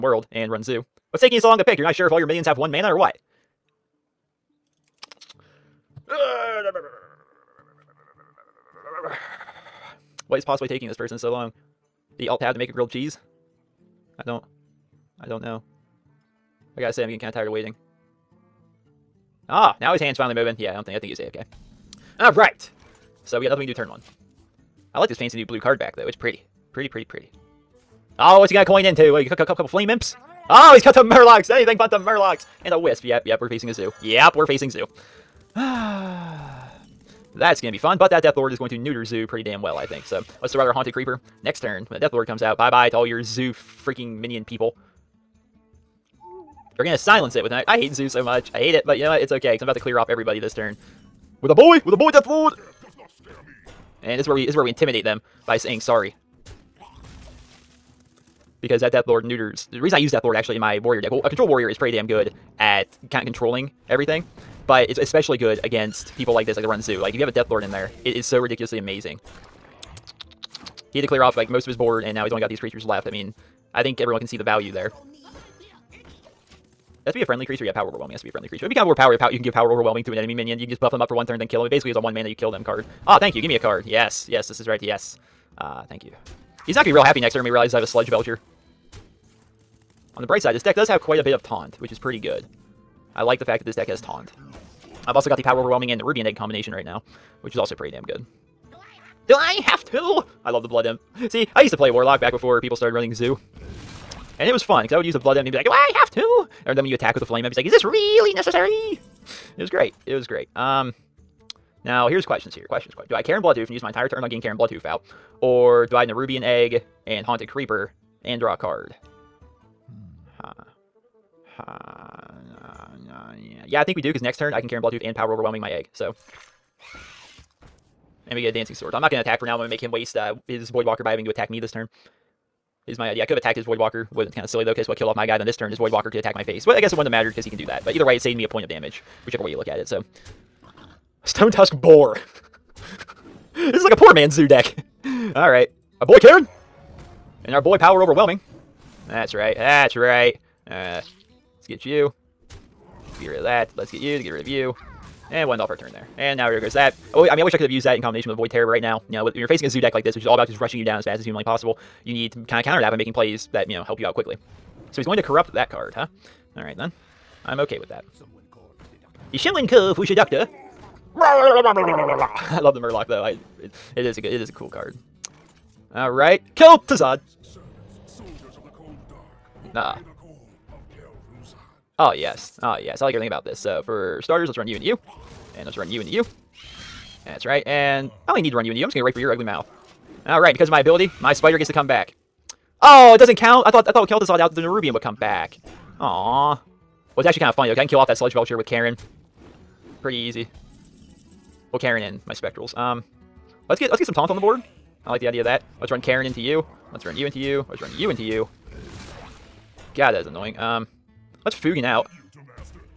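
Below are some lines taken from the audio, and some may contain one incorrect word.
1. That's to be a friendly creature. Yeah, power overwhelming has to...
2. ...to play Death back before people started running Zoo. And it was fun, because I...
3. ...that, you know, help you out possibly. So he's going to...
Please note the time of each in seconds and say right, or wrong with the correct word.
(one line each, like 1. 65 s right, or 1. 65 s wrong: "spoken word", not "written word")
1. 77 s right
2. 101 s wrong: "Warlock", not "Death"
3. 163 s wrong: "quickly", not "possibly".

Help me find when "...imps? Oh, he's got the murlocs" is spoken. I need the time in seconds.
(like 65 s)
29 s.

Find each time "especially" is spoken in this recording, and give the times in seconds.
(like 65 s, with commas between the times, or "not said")
64 s.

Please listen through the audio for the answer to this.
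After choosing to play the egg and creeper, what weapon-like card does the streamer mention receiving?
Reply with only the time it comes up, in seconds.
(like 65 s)
128 s.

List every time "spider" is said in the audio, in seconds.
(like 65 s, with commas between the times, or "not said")
191 s.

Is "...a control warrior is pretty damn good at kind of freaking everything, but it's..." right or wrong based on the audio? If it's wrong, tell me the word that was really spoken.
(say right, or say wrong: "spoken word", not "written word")
wrong: "controlling", not "freaking".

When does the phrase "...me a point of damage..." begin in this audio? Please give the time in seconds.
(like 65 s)
138 s.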